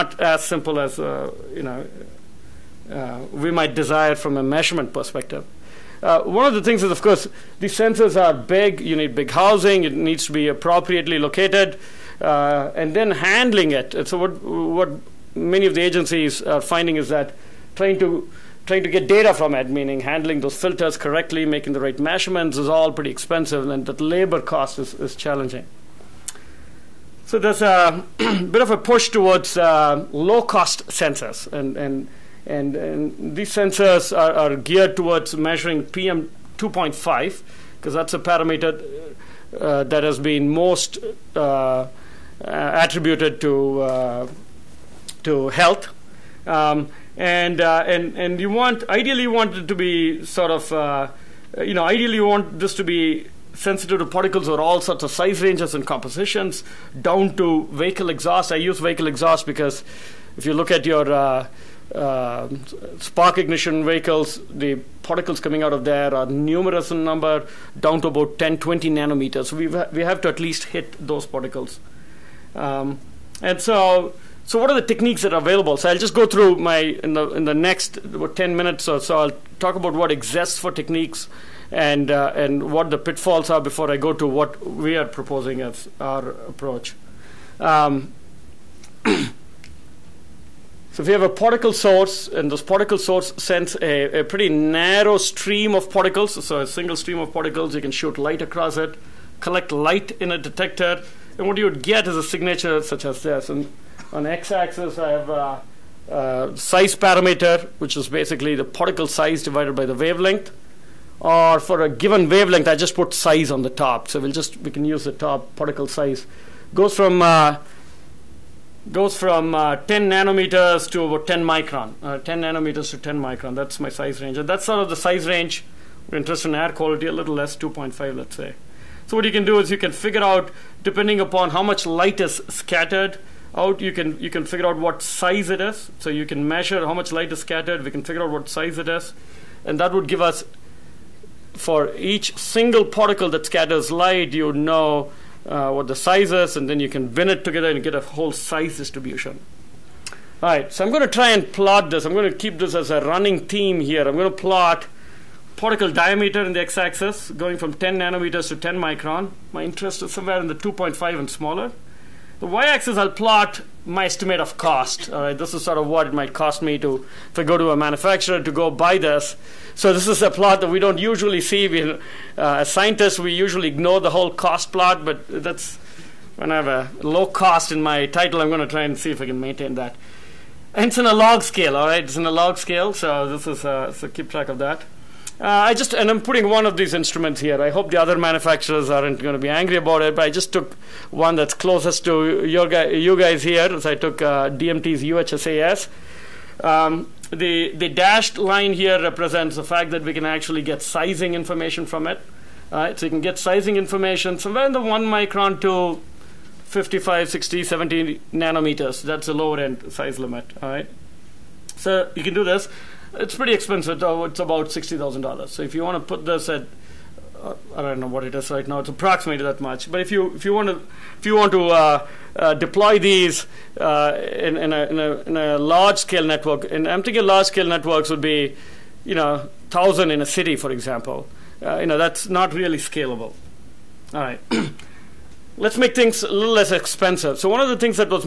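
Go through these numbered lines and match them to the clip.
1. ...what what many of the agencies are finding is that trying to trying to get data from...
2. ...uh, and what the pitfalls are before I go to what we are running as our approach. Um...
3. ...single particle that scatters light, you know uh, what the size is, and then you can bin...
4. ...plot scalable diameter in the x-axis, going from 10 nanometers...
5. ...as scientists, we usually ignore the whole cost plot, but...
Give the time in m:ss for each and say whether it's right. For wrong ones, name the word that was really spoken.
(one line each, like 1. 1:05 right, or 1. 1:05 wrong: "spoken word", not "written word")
1. 0:14 right
2. 1:22 wrong: "proposing", not "running"
3. 2:22 right
4. 2:34 wrong: "particle", not "scalable"
5. 2:52 right.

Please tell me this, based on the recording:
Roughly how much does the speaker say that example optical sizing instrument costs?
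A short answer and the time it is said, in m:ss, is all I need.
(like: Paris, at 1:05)
$60,000, at 3:34.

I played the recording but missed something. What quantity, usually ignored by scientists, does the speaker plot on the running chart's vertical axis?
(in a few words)
estimate of cost.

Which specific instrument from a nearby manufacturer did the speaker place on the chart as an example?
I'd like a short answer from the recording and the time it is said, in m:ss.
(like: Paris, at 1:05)
DMT's UHSAS, at 3:14.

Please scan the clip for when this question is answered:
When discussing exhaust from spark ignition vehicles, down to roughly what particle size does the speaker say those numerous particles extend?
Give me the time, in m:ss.
1:08.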